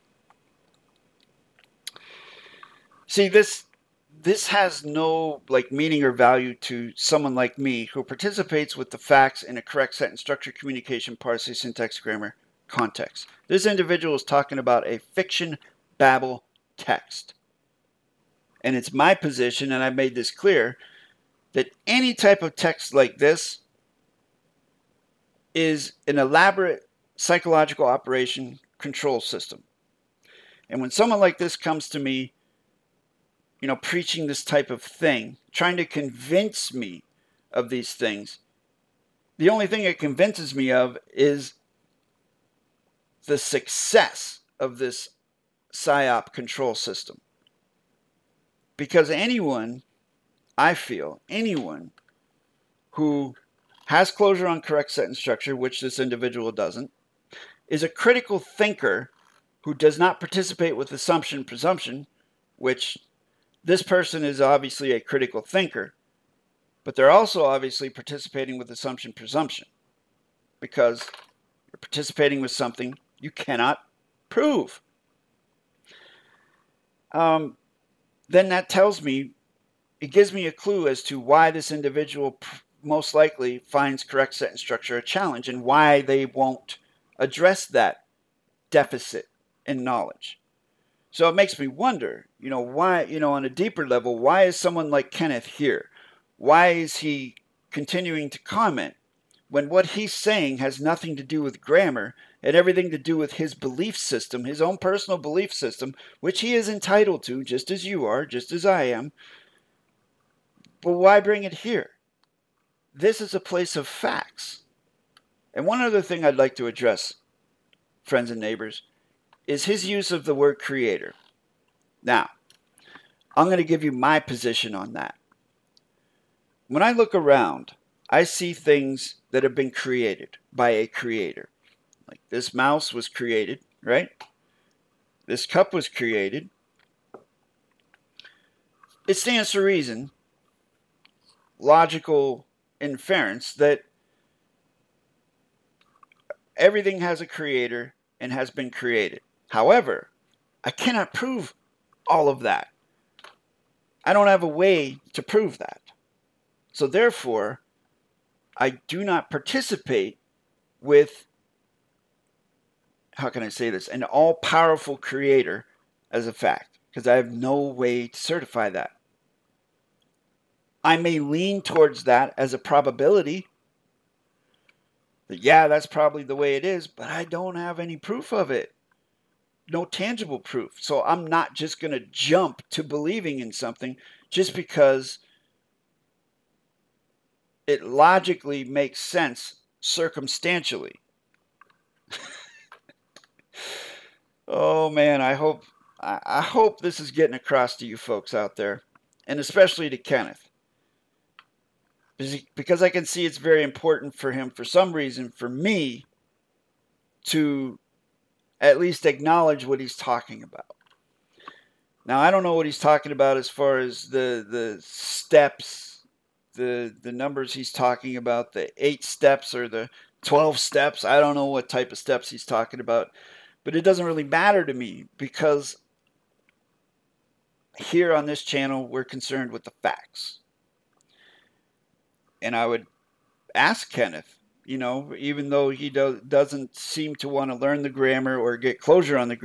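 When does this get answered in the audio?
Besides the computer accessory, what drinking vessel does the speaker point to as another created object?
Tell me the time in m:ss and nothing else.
2:15.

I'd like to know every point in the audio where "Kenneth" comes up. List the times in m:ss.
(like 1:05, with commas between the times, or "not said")
1:35, 3:19, 3:53.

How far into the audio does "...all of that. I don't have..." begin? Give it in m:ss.
2:32.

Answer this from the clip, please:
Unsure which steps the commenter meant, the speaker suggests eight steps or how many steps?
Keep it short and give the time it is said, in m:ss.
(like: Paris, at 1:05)
12, at 3:40.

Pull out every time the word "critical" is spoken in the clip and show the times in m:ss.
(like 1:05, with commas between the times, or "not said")
0:57, 1:04.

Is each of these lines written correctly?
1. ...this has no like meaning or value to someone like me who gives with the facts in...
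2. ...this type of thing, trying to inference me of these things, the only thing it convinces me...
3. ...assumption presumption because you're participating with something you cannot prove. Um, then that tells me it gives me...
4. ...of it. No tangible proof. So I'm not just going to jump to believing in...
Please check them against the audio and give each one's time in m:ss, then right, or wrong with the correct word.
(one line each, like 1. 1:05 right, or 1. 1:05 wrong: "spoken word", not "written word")
1. 0:04 wrong: "participates", not "gives"
2. 0:34 wrong: "convince", not "inference"
3. 1:08 right
4. 2:58 right.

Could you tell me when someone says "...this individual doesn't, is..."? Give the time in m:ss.
0:55.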